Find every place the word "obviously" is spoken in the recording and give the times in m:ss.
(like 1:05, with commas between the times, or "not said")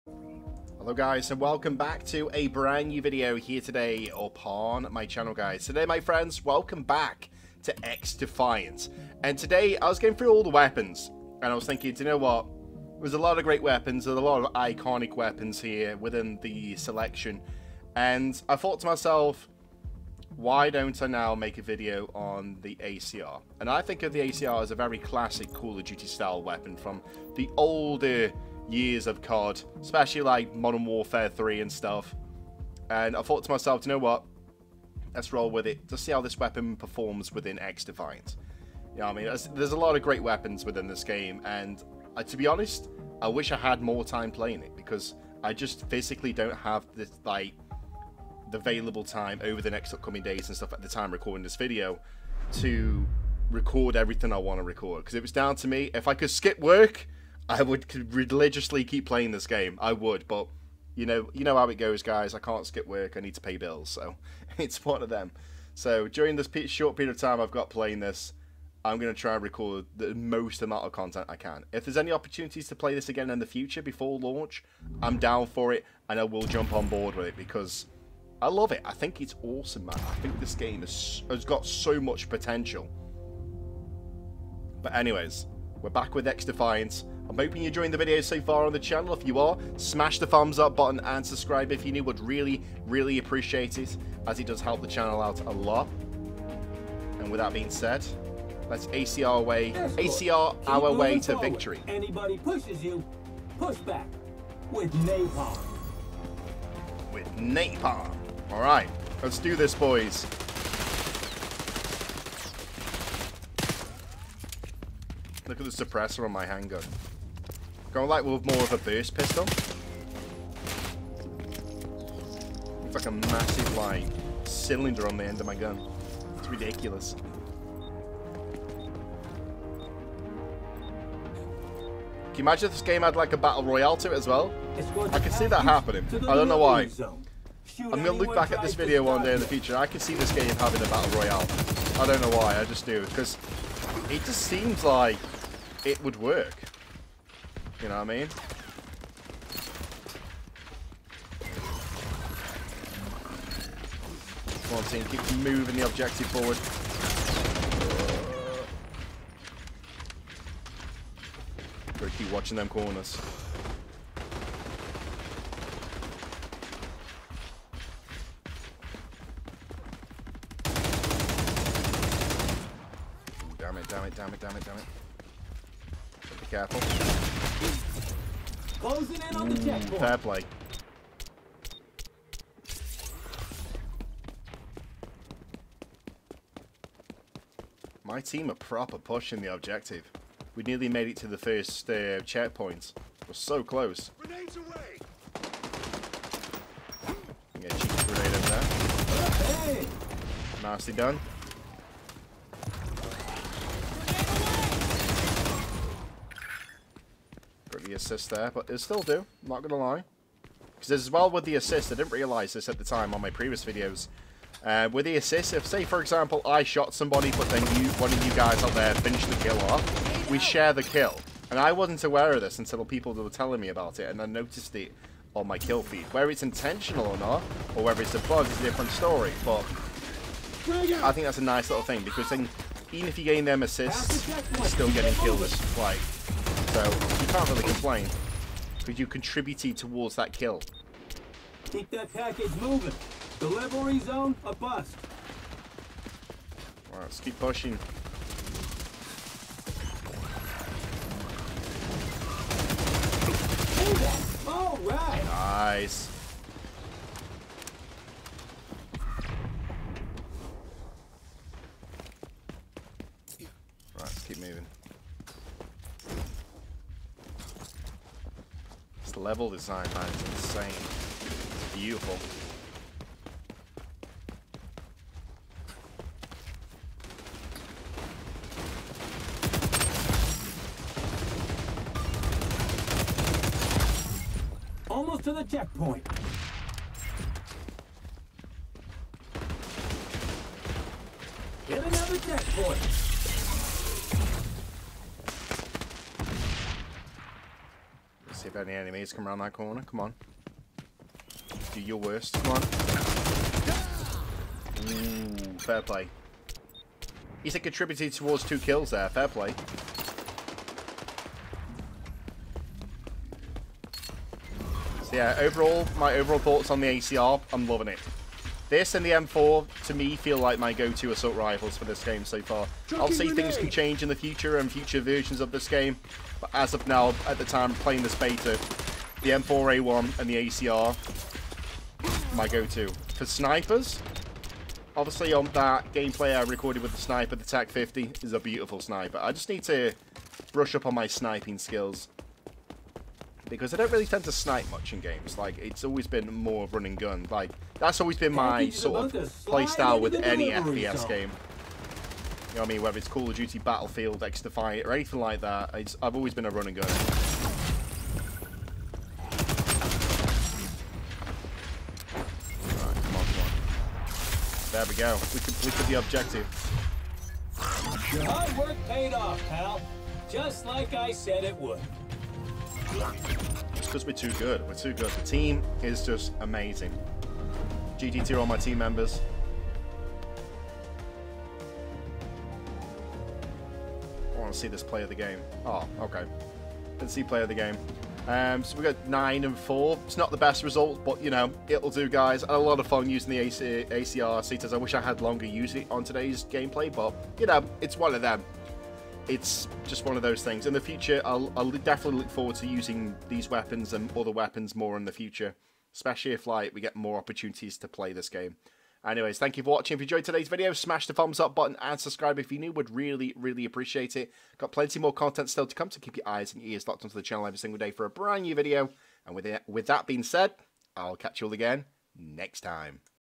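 5:34.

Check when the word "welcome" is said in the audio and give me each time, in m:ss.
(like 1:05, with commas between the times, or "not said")
0:01, 0:06.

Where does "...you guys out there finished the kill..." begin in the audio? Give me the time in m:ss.
3:38.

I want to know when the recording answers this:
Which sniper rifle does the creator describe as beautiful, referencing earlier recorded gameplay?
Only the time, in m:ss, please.
5:37.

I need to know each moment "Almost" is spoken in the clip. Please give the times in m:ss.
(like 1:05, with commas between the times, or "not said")
4:44.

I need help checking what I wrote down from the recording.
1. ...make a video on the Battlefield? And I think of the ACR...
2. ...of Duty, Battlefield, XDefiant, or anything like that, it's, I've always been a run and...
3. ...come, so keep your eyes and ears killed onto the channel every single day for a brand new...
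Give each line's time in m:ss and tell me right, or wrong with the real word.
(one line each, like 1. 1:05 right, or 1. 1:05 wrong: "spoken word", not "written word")
1. 0:21 wrong: "ACR", not "Battlefield"
2. 5:53 right
3. 6:55 wrong: "locked", not "killed".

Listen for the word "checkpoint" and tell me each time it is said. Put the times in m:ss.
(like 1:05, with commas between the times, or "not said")
2:59, 3:12, 4:45, 4:52.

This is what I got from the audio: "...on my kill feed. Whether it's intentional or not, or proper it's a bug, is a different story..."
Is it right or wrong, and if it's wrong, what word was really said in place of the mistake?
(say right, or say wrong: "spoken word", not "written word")
wrong: "whether", not "proper".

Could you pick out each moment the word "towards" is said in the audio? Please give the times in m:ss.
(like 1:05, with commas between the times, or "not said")
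3:59, 5:08.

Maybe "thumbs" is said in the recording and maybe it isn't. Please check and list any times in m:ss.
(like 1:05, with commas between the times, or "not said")
1:30, 6:51.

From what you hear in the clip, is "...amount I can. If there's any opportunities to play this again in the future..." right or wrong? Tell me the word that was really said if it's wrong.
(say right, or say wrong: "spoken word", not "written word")
wrong: "content", not "amount".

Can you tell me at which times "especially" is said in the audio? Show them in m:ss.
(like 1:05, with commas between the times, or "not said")
0:29, 6:45.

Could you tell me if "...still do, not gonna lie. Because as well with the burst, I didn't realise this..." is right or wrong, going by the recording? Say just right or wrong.
wrong.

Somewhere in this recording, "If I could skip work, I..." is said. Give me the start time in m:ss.
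0:55.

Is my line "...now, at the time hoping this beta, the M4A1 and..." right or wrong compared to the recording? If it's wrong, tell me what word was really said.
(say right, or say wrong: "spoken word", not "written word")
wrong: "playing", not "hoping".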